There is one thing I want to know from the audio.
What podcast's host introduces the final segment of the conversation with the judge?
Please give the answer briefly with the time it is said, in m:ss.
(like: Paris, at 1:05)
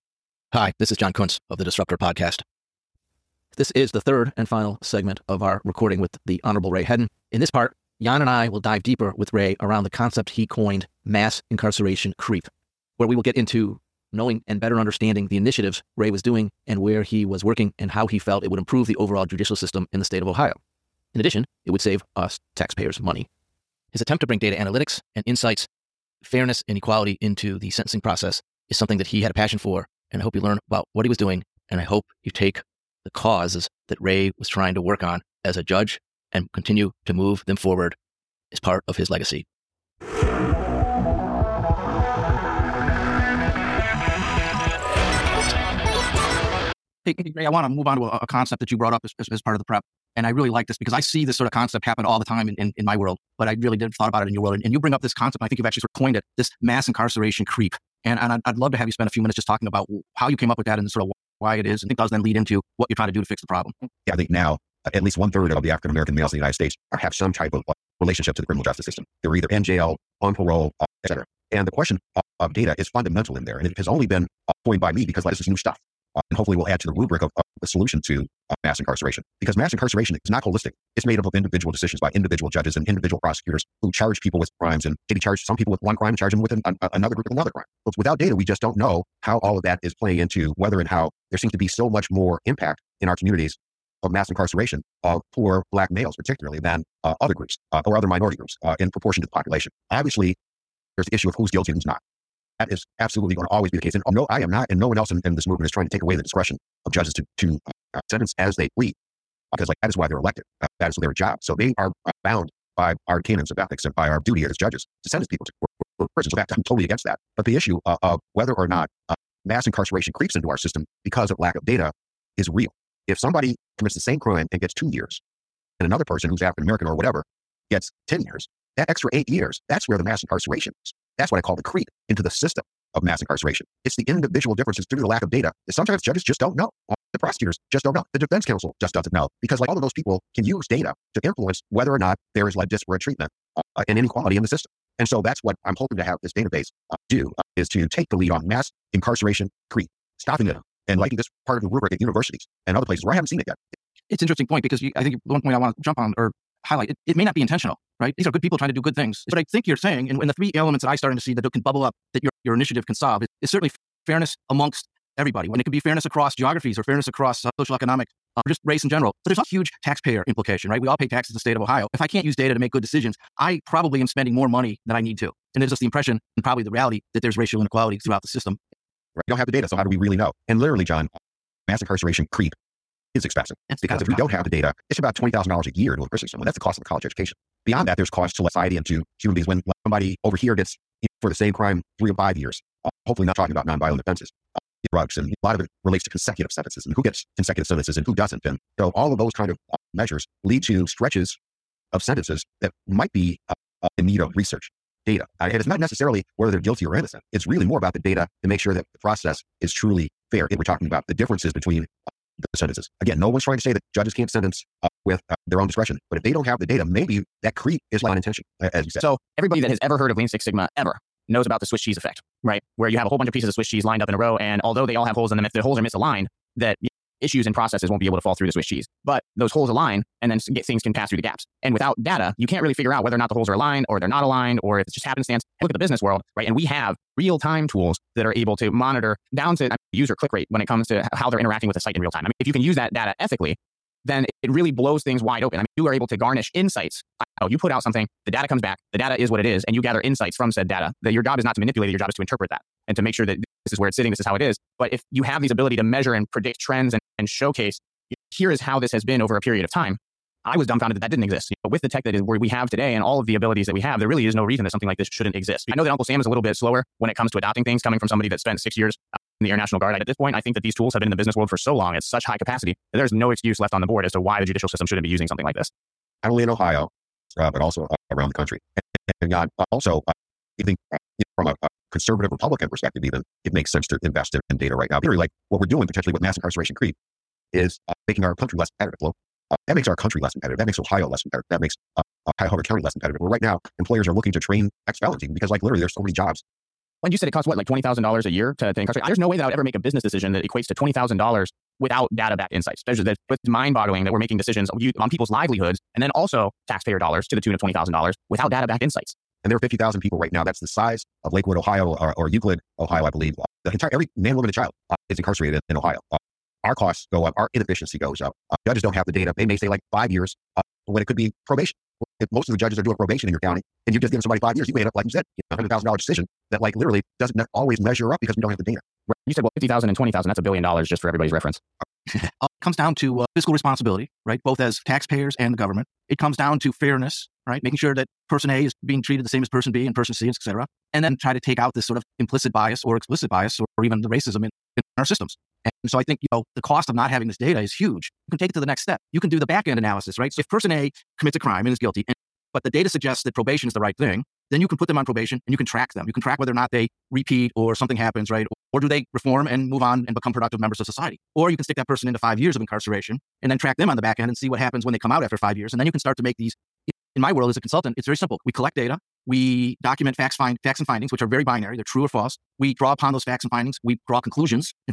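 Disruptor Podcast, at 0:01.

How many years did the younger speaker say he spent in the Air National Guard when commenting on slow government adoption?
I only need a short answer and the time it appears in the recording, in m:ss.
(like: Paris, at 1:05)
6, at 4:28.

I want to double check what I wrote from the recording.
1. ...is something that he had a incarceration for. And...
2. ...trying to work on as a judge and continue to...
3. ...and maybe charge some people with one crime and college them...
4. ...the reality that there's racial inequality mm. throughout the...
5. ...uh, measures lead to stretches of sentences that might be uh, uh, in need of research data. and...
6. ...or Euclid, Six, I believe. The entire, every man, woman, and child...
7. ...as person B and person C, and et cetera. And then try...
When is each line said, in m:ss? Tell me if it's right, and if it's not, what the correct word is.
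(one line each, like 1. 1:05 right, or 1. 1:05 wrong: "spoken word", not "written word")
1. 0:28 wrong: "passion", not "incarceration"
2. 0:34 right
3. 1:24 wrong: "charge", not "college"
4. 2:56 right
5. 3:19 right
6. 5:12 wrong: "Ohio", not "Six"
7. 5:39 right.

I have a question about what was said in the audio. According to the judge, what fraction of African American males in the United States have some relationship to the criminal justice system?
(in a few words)
one third.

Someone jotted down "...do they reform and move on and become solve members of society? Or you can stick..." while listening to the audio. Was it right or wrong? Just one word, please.
wrong.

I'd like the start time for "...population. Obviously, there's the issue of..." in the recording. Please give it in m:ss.
1:39.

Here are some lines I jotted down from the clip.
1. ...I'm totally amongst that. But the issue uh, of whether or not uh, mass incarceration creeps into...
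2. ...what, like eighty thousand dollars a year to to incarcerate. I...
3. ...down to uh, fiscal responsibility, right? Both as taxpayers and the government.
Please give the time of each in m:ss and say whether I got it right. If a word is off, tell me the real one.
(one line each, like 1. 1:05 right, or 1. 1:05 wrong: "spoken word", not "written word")
1. 1:56 wrong: "against", not "amongst"
2. 4:57 wrong: "twenty", not "eighty"
3. 5:32 right.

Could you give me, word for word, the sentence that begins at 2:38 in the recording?
These are good people trying to do good things.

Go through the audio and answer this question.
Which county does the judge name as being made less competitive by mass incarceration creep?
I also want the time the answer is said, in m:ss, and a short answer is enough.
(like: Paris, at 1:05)
Cuyahoga County, at 4:52.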